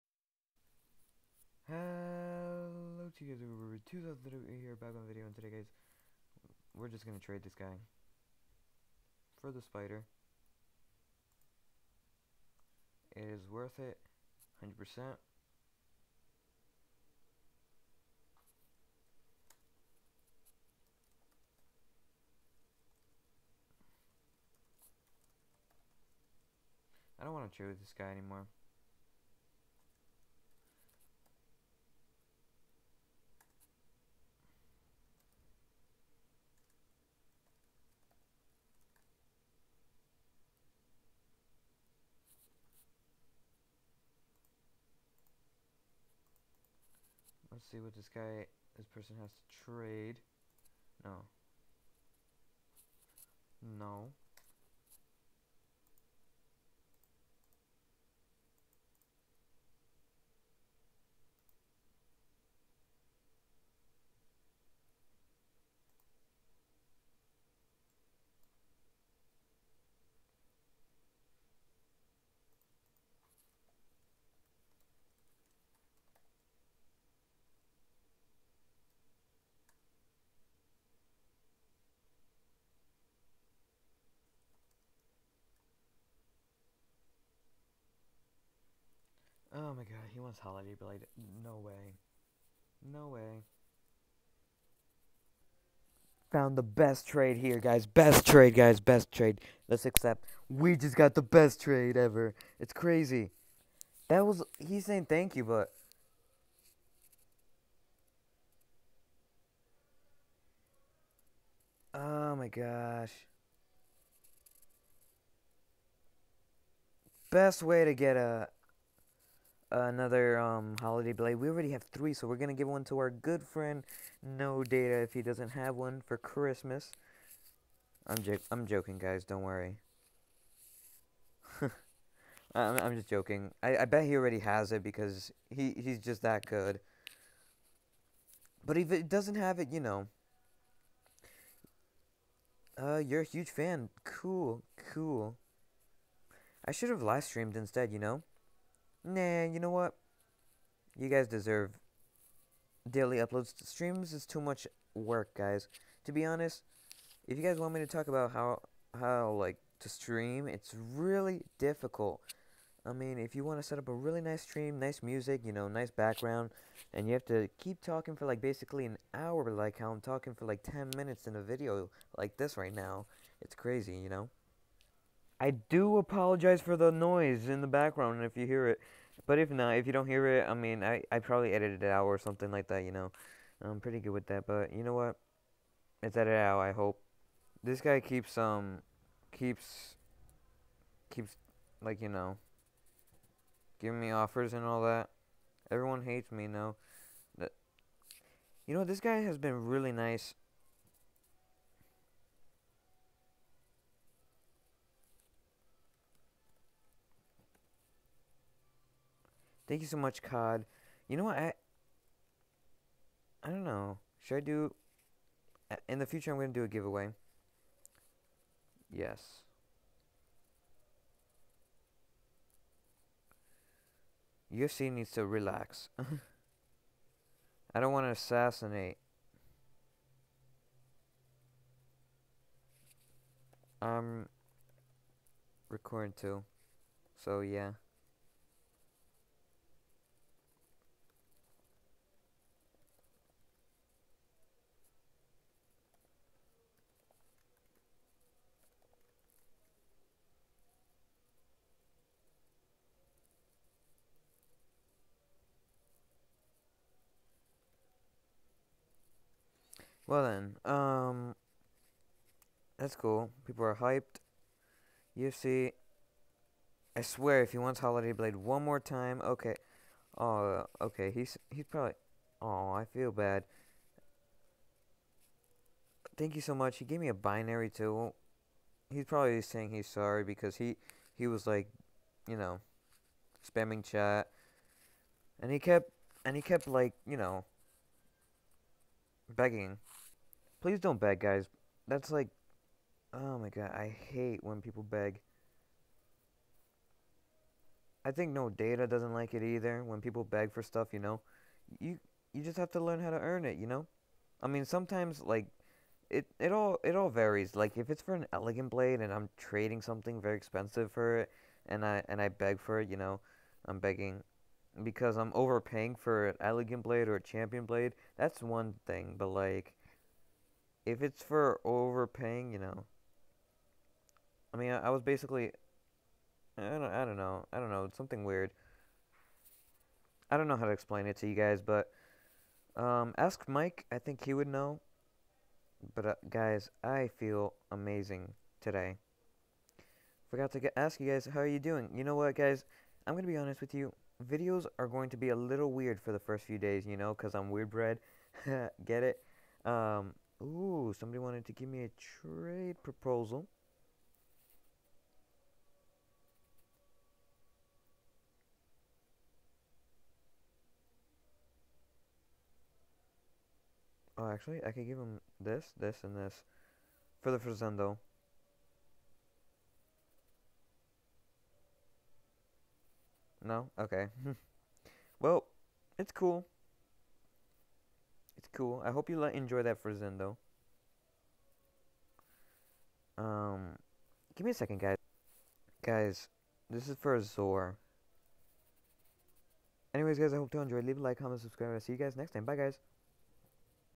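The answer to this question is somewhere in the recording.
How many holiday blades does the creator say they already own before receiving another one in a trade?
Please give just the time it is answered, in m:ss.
2:01.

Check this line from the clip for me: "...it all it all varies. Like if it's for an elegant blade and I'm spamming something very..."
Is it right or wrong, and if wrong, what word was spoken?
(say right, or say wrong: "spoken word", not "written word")
wrong: "trading", not "spamming".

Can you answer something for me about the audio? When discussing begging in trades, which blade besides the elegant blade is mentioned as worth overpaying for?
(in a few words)
champion blade.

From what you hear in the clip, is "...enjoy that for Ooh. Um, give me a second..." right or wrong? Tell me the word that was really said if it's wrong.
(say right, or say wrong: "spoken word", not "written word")
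wrong: "Zendo", not "Ooh".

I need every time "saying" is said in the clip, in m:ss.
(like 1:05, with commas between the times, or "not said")
1:44, 4:39.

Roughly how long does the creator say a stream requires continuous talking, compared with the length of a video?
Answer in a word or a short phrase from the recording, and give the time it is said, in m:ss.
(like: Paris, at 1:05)
an hour, at 2:48.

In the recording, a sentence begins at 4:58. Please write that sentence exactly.
I think no data doesn't like it either.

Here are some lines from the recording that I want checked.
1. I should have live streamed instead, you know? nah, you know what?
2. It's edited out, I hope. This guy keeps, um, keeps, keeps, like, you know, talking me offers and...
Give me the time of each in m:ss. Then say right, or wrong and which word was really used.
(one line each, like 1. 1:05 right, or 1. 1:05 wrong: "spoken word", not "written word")
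1. 2:26 right
2. 3:06 wrong: "giving", not "talking".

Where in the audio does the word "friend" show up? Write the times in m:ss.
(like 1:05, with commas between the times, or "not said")
2:03.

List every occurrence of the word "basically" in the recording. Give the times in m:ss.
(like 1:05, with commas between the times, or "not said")
2:48, 5:25.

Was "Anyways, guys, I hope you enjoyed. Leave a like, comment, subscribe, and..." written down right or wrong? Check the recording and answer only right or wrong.
right.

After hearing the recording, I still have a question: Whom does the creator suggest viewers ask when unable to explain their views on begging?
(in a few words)
Mike.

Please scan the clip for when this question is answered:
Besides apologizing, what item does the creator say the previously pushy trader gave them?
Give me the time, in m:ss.
4:37.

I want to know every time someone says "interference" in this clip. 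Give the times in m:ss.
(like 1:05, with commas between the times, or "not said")
not said.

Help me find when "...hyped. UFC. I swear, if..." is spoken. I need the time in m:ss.
4:23.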